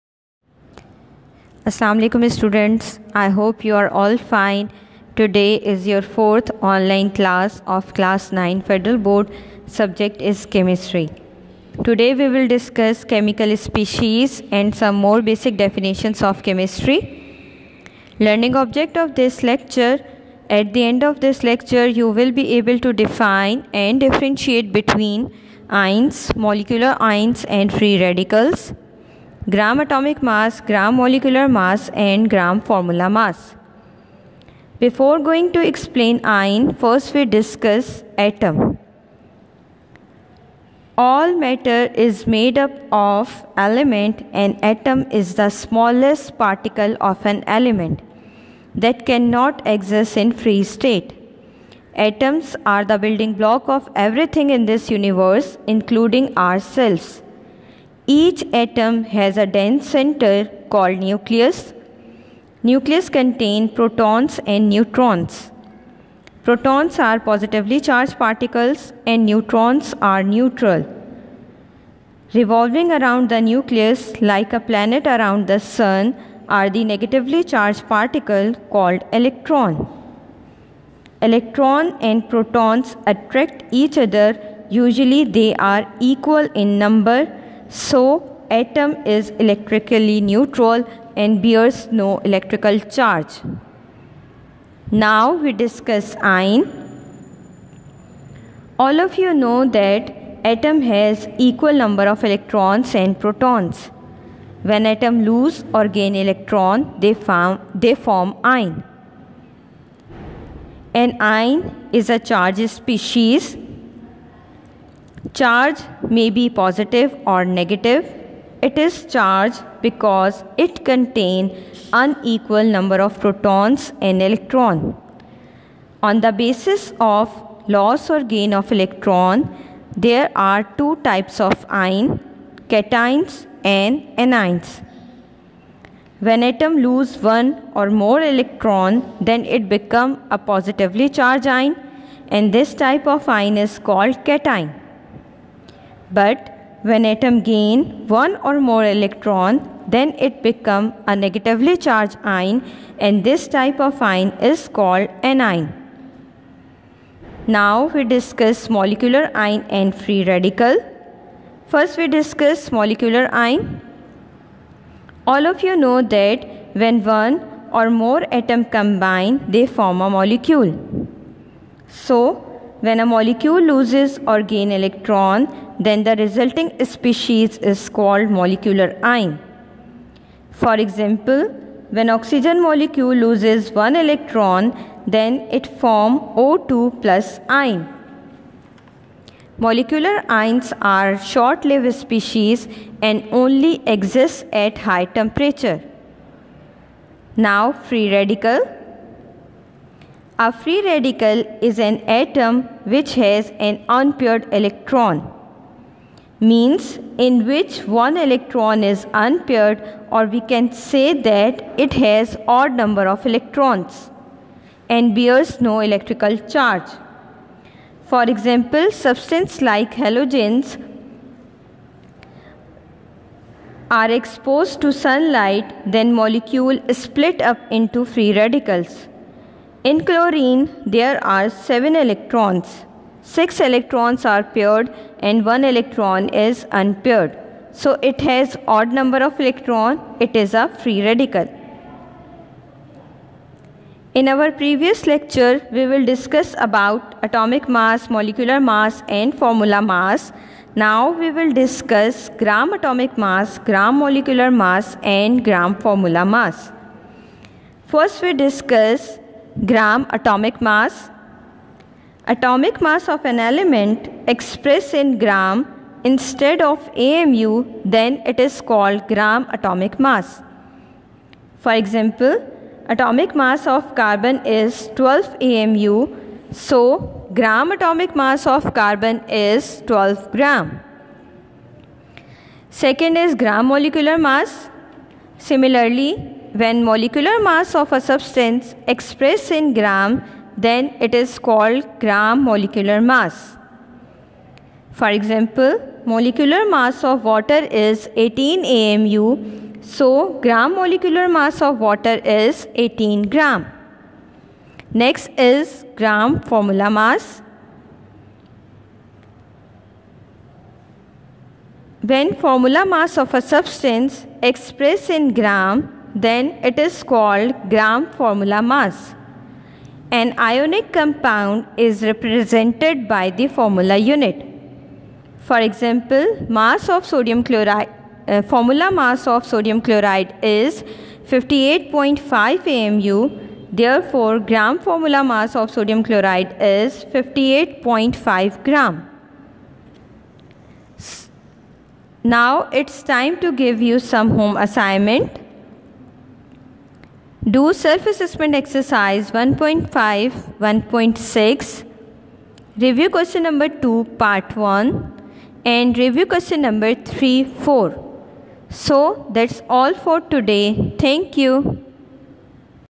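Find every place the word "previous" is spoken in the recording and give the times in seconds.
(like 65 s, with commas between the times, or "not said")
244 s.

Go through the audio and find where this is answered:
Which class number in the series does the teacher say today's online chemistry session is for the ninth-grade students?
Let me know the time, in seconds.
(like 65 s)
6 s.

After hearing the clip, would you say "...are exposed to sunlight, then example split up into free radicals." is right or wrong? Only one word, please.
wrong.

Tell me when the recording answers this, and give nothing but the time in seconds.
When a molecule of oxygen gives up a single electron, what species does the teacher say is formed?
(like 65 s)
186 s.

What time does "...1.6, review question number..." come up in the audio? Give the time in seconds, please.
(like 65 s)
350 s.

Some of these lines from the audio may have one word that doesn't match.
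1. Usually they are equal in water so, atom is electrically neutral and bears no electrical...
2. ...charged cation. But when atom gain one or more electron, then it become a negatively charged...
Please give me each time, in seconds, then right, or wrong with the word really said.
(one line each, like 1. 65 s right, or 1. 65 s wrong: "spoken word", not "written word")
1. 84 s wrong: "number", not "water"
2. 143 s wrong: "called", not "charged".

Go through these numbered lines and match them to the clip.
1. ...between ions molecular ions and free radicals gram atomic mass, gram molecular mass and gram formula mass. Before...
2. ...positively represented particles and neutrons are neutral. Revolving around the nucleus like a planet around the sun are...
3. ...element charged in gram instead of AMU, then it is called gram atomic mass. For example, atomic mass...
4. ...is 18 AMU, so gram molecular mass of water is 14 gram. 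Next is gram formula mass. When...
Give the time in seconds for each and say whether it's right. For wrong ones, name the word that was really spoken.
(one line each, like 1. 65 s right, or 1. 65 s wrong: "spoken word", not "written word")
1. 24 s right
2. 67 s wrong: "charged", not "represented"
3. 263 s wrong: "expressed", not "charged"
4. 297 s wrong: "18", not "14".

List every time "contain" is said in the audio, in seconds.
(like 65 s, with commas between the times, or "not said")
63 s, 120 s.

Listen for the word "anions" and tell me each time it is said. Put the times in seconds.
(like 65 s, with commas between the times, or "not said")
134 s, 155 s.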